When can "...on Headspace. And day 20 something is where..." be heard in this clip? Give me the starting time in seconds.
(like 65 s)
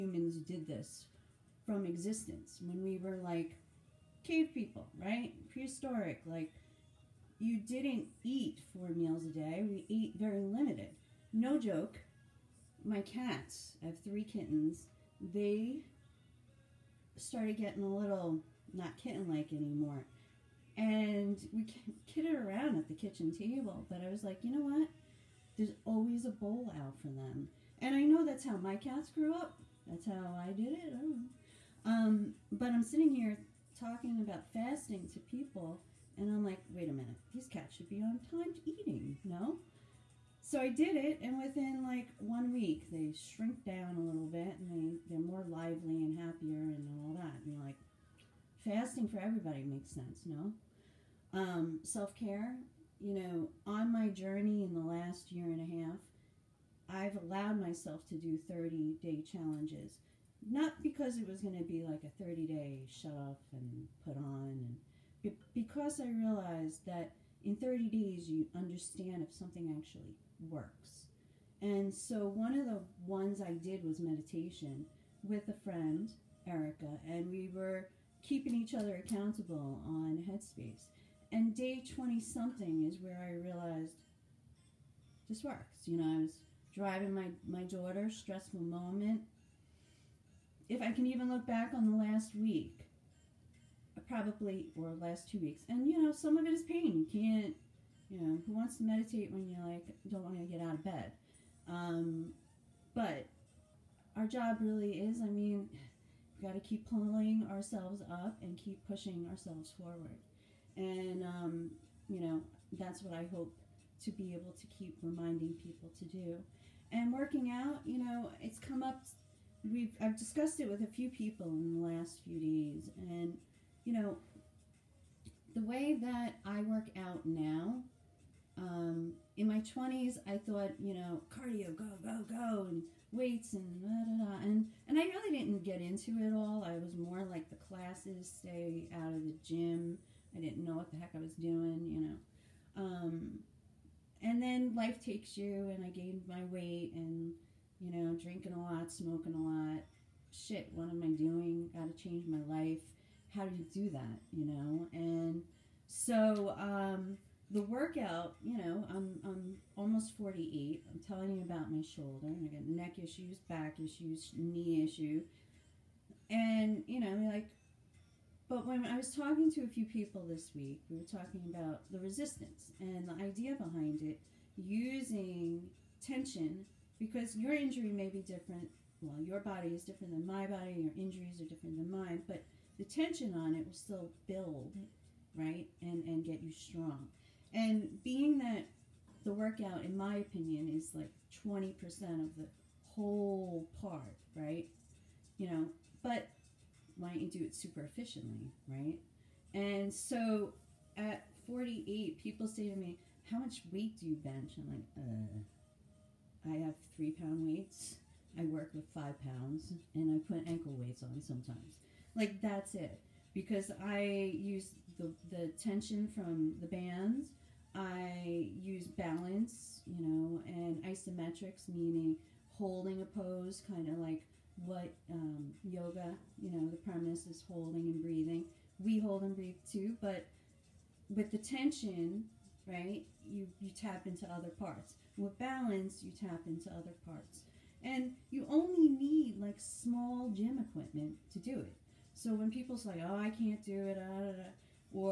79 s.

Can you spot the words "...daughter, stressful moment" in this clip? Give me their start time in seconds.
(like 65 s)
87 s.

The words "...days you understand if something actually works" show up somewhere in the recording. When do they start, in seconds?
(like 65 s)
67 s.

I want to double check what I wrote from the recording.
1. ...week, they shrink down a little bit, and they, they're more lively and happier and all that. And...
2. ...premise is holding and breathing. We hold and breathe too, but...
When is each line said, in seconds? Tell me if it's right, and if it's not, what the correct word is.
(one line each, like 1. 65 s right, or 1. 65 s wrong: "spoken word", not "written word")
1. 42 s right
2. 226 s right.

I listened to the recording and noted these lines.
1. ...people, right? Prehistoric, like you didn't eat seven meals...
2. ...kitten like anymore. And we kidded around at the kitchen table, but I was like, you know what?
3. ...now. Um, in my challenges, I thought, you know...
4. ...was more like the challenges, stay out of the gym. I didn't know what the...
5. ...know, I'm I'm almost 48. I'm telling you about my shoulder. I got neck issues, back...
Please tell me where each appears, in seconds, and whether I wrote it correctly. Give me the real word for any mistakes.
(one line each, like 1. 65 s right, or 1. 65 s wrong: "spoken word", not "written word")
1. 4 s wrong: "four", not "seven"
2. 18 s right
3. 127 s wrong: "twenties", not "challenges"
4. 136 s wrong: "classes", not "challenges"
5. 158 s right.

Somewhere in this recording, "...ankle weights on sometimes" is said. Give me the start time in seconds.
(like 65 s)
210 s.